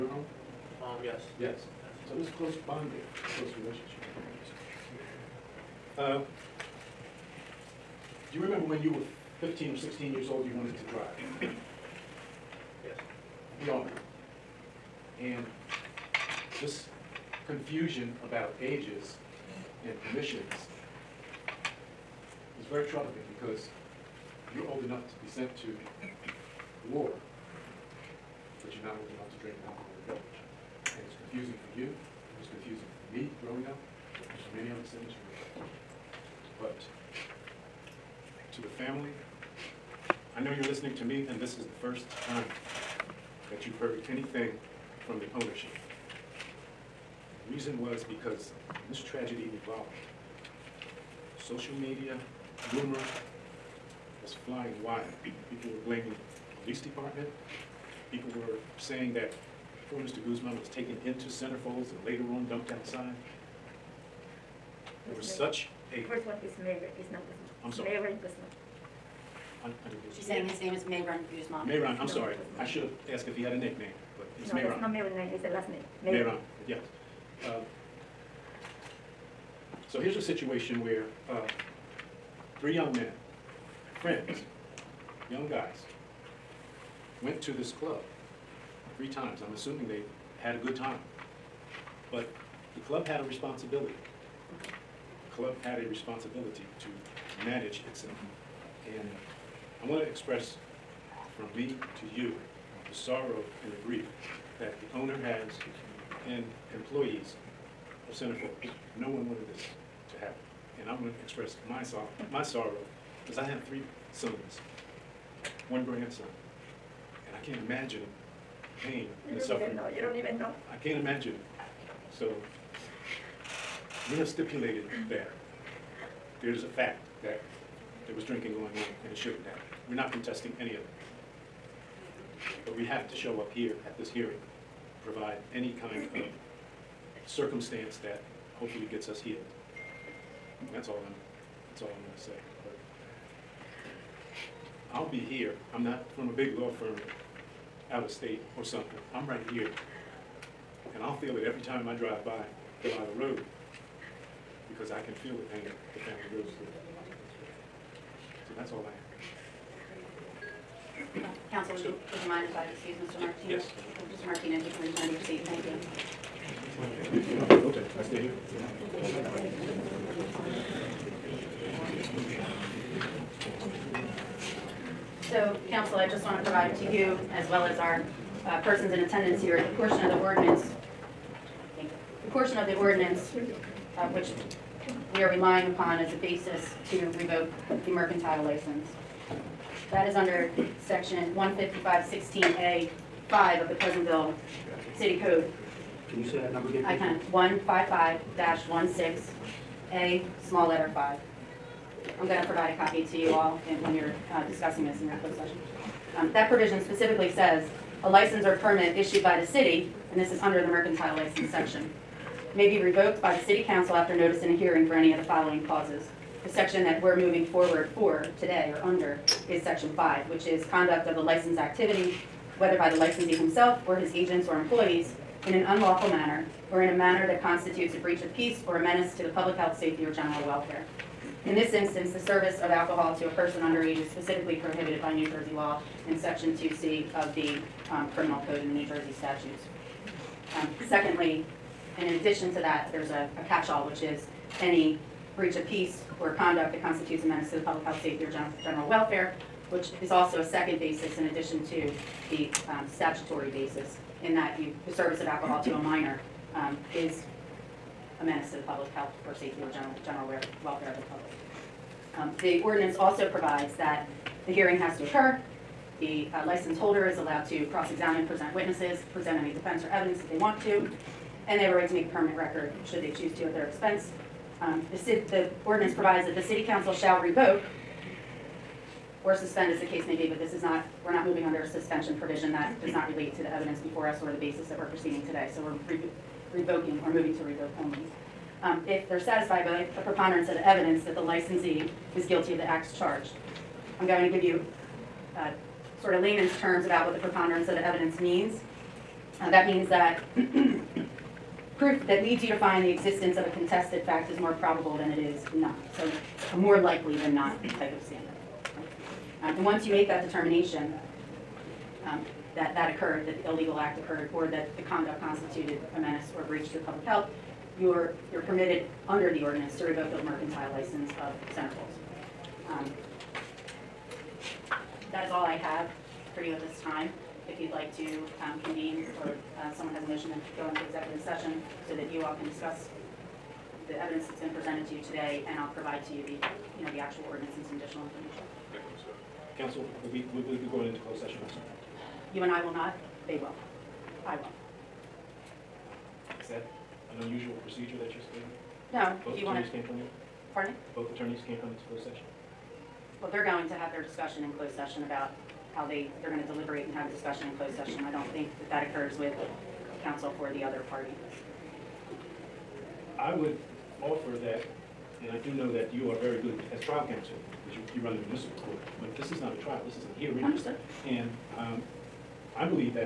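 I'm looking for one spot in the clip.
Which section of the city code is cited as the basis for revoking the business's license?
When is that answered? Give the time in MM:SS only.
03:11.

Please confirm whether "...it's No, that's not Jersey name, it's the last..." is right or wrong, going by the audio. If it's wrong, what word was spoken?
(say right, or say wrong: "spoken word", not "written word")
wrong: "Mary", not "Jersey".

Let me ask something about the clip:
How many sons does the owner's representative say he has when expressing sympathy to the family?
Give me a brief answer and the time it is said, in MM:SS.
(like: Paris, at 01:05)
3, at 01:53.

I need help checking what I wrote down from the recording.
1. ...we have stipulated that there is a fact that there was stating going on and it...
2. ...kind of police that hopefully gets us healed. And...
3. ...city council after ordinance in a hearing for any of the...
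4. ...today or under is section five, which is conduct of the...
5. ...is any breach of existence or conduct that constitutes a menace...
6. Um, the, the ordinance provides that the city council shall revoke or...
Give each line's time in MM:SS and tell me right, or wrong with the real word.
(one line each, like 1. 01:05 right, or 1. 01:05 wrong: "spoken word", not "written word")
1. 02:04 wrong: "drinking", not "stating"
2. 02:15 wrong: "circumstance", not "police"
3. 03:33 wrong: "notice", not "ordinance"
4. 03:38 right
5. 04:04 wrong: "peace", not "existence"
6. 04:34 right.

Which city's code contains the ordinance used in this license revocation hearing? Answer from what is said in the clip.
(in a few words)
Pleasantville.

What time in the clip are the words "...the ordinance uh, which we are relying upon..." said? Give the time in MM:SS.
03:02.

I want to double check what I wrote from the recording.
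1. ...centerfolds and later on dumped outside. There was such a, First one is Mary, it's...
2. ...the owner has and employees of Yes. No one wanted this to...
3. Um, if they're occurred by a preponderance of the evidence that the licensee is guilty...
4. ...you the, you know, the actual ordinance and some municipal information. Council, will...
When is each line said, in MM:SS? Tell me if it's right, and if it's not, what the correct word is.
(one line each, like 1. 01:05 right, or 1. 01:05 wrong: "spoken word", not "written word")
1. 01:01 right
2. 01:44 wrong: "Centerfold", not "Yes"
3. 04:48 wrong: "satisfied", not "occurred"
4. 05:36 wrong: "additional", not "municipal".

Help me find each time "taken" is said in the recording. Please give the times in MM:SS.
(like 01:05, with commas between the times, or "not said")
01:00.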